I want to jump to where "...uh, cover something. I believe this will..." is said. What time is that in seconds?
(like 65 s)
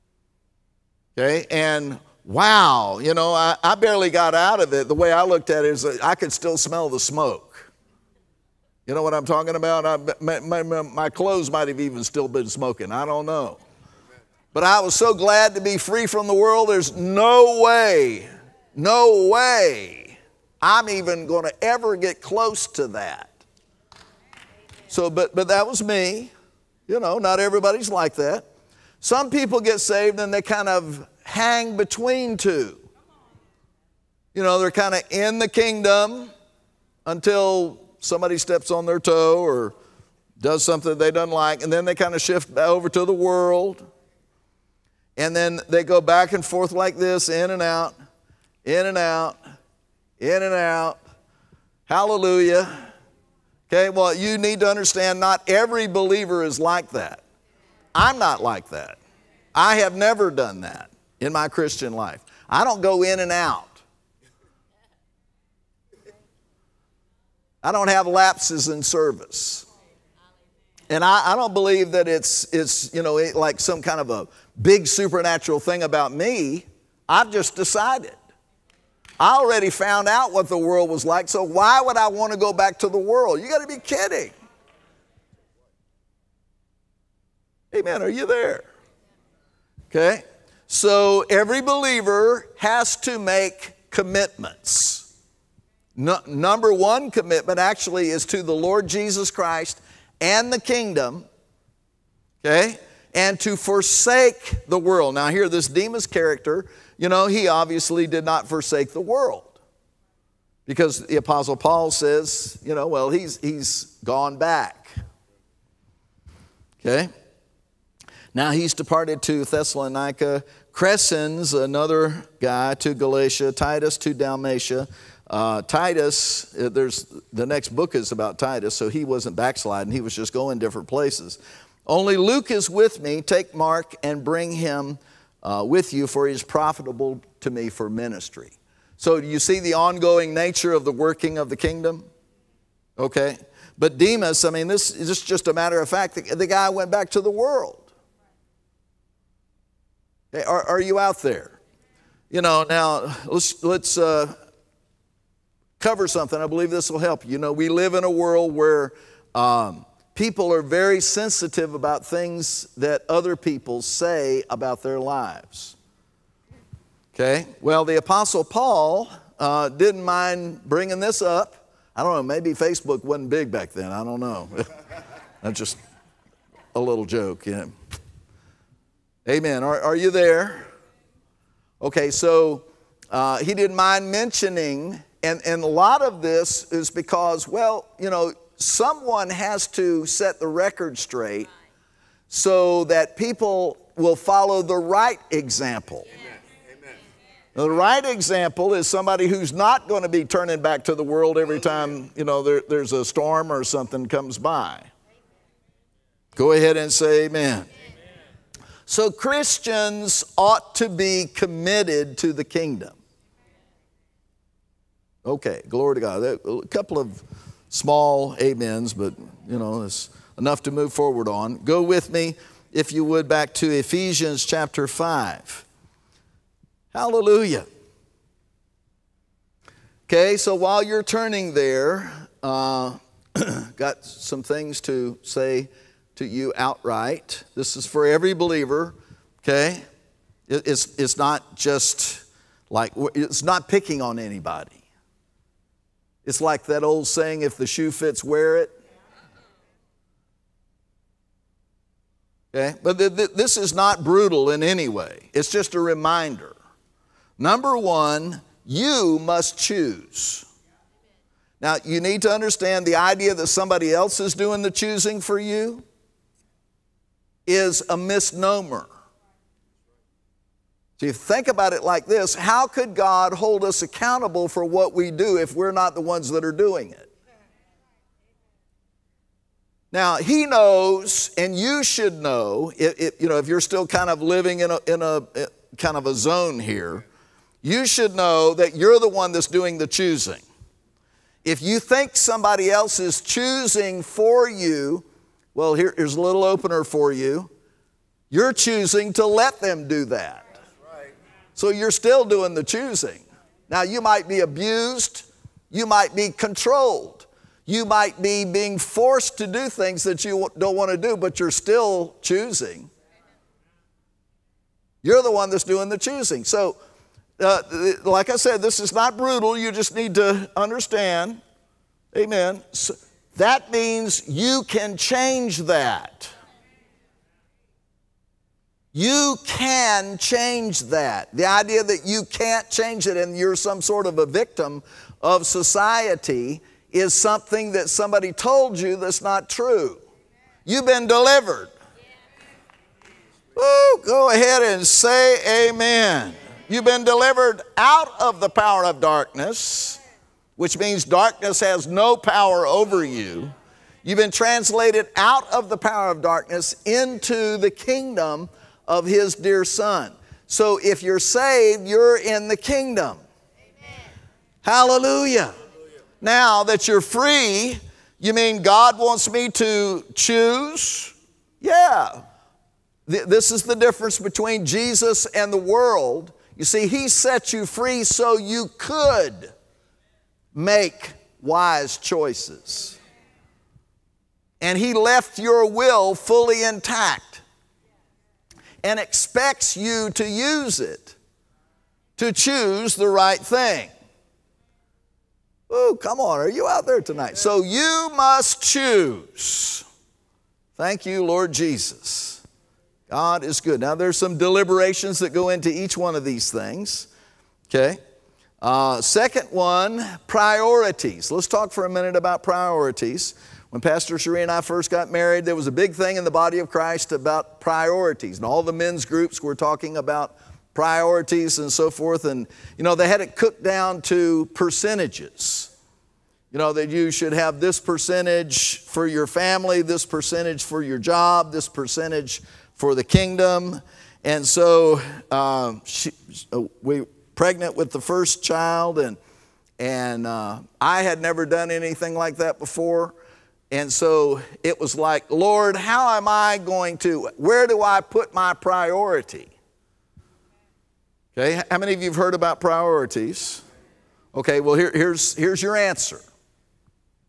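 153 s.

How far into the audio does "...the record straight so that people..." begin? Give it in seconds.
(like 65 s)
190 s.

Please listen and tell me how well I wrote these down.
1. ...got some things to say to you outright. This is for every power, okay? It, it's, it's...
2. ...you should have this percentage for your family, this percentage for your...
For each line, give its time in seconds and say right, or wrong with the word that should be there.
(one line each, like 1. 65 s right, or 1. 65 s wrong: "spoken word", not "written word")
1. 233 s wrong: "believer", not "power"
2. 426 s right.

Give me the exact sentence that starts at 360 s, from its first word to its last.
So if you're saved, you're in the kingdom.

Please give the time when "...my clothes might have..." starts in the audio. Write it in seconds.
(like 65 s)
10 s.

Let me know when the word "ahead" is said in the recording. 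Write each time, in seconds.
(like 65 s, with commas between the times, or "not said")
206 s, 344 s.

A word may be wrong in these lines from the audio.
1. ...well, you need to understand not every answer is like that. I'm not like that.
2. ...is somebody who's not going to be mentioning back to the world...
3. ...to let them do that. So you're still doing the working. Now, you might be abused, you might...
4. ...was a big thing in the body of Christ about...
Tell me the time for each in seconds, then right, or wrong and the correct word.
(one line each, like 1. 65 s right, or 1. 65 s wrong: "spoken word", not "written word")
1. 53 s wrong: "believer", not "answer"
2. 198 s wrong: "turning", not "mentioning"
3. 299 s wrong: "choosing", not "working"
4. 415 s right.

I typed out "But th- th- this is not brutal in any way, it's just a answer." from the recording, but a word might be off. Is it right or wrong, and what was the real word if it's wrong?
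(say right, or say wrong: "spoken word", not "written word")
wrong: "reminder", not "answer".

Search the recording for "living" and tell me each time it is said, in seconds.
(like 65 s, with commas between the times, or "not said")
284 s.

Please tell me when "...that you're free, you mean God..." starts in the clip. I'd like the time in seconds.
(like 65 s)
366 s.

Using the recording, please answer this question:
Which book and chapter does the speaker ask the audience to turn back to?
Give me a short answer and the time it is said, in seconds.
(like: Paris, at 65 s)
Ephesians 5, at 223 s.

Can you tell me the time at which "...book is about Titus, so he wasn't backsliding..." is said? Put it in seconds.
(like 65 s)
127 s.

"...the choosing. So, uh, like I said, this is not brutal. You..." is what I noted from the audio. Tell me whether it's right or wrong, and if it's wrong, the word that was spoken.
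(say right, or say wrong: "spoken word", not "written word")
right.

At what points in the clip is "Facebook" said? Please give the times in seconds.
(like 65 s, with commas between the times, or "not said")
172 s.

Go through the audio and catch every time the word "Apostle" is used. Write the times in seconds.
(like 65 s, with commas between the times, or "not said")
111 s, 167 s.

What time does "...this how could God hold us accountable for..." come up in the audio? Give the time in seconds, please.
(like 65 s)
272 s.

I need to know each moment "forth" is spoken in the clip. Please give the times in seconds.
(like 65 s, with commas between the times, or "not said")
46 s, 421 s.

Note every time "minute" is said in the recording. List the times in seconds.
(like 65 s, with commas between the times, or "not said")
411 s.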